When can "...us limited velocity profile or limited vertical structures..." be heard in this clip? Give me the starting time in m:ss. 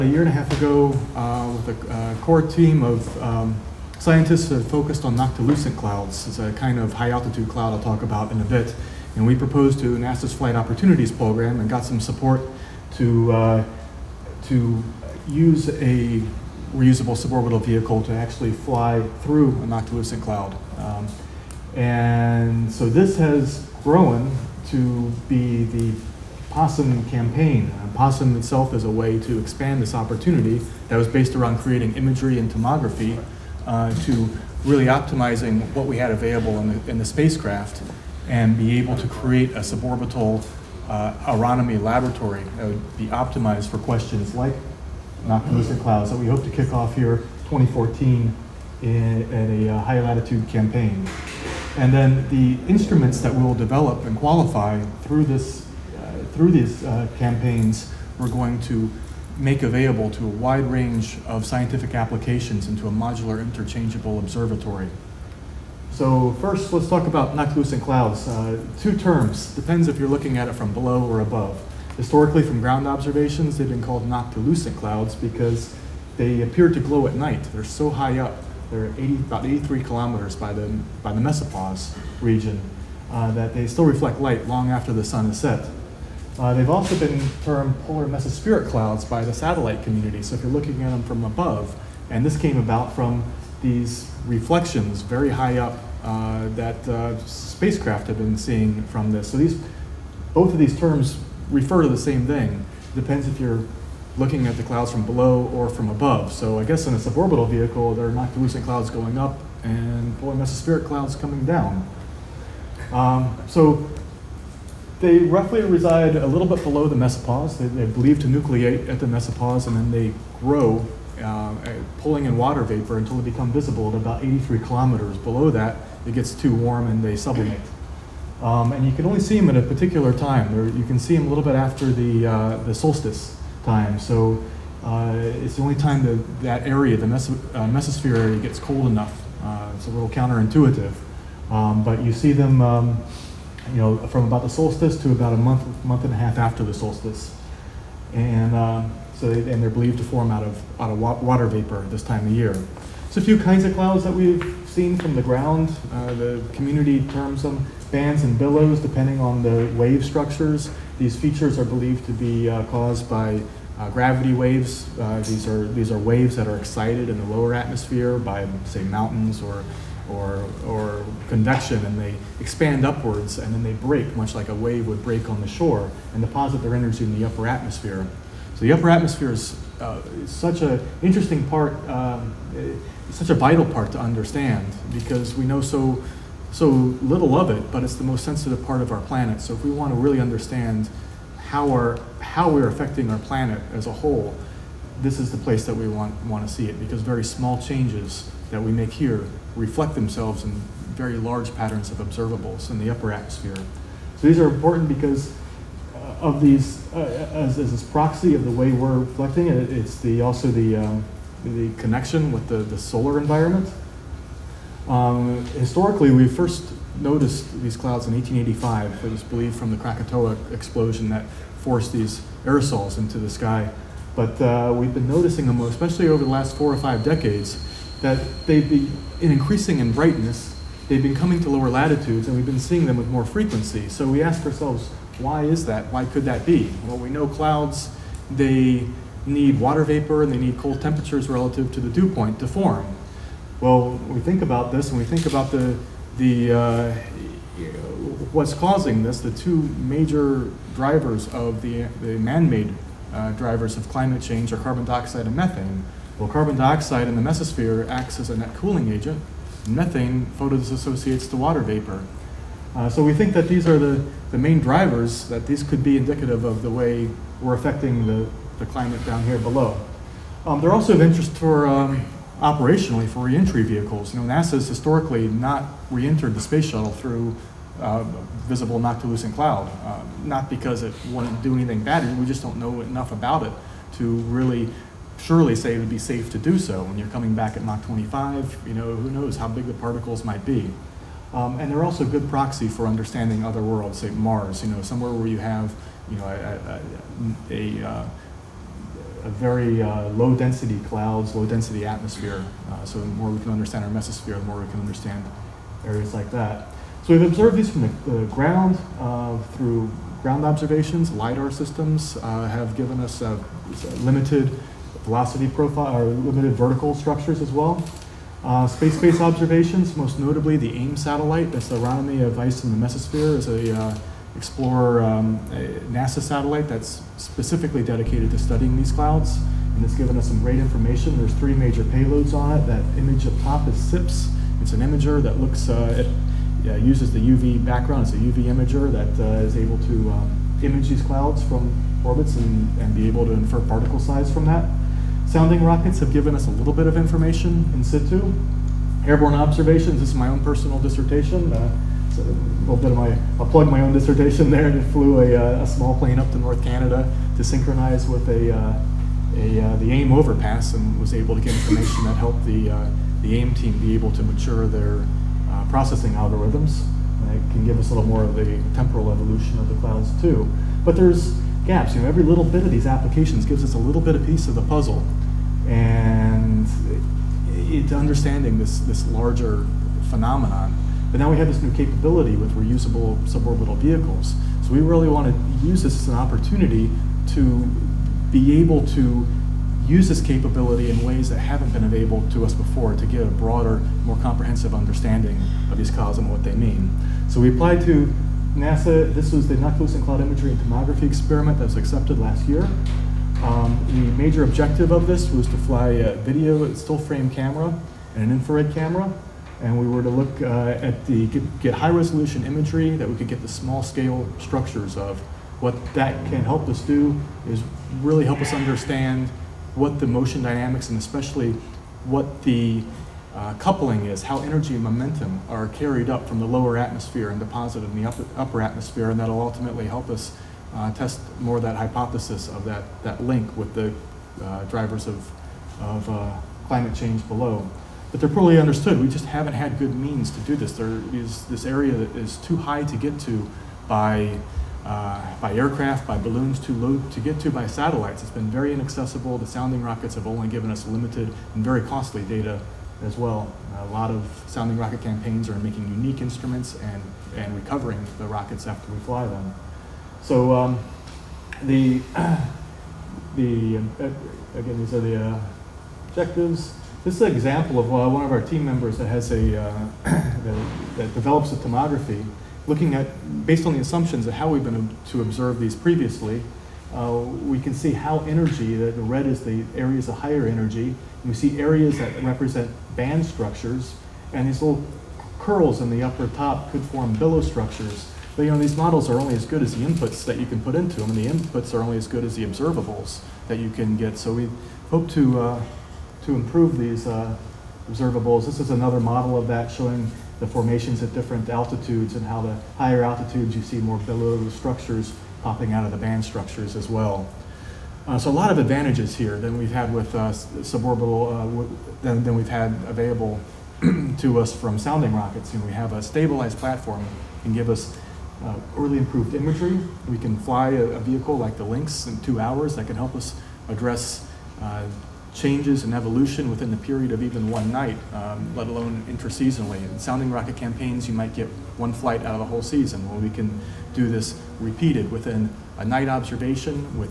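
5:12.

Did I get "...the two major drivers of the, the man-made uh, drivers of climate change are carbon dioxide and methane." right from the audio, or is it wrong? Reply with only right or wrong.
right.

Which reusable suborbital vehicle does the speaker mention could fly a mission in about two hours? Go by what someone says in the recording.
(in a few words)
Lynx.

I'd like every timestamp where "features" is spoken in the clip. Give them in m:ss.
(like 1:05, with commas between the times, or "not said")
2:41.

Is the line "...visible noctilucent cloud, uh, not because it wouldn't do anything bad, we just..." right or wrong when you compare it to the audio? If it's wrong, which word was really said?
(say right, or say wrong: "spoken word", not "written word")
right.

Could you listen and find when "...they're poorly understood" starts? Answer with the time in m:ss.
7:18.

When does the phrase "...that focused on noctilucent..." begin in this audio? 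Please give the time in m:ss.
0:04.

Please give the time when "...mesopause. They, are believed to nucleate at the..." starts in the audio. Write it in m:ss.
1:56.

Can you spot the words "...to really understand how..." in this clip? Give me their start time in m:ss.
3:09.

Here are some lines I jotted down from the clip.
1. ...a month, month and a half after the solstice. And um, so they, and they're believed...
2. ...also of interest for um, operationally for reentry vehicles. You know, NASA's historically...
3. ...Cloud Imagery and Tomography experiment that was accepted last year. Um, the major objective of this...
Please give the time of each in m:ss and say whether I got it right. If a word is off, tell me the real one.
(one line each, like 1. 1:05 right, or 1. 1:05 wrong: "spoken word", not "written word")
1. 2:25 right
2. 4:30 right
3. 6:40 right.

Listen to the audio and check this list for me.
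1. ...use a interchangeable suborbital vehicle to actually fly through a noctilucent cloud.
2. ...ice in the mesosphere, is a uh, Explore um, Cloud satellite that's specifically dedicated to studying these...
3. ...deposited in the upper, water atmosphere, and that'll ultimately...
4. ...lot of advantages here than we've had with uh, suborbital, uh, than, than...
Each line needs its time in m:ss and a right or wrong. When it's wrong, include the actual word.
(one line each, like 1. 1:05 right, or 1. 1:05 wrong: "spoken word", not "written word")
1. 0:15 wrong: "reusable", not "interchangeable"
2. 5:22 wrong: "NASA", not "Cloud"
3. 7:07 wrong: "upper", not "water"
4. 8:28 right.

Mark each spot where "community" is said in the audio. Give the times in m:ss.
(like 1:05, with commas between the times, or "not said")
1:29, 2:36.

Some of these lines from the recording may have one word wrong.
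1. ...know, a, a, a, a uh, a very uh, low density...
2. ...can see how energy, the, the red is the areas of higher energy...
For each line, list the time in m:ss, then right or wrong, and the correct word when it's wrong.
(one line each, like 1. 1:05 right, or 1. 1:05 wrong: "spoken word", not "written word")
1. 4:56 right
2. 7:57 right.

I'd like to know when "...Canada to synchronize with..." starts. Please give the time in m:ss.
5:56.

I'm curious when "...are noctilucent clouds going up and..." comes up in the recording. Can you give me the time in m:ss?
1:48.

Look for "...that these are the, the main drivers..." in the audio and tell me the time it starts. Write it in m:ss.
4:23.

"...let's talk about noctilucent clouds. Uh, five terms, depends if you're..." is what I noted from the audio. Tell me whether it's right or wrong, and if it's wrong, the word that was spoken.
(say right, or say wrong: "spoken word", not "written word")
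wrong: "two", not "five".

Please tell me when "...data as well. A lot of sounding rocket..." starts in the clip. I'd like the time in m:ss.
7:32.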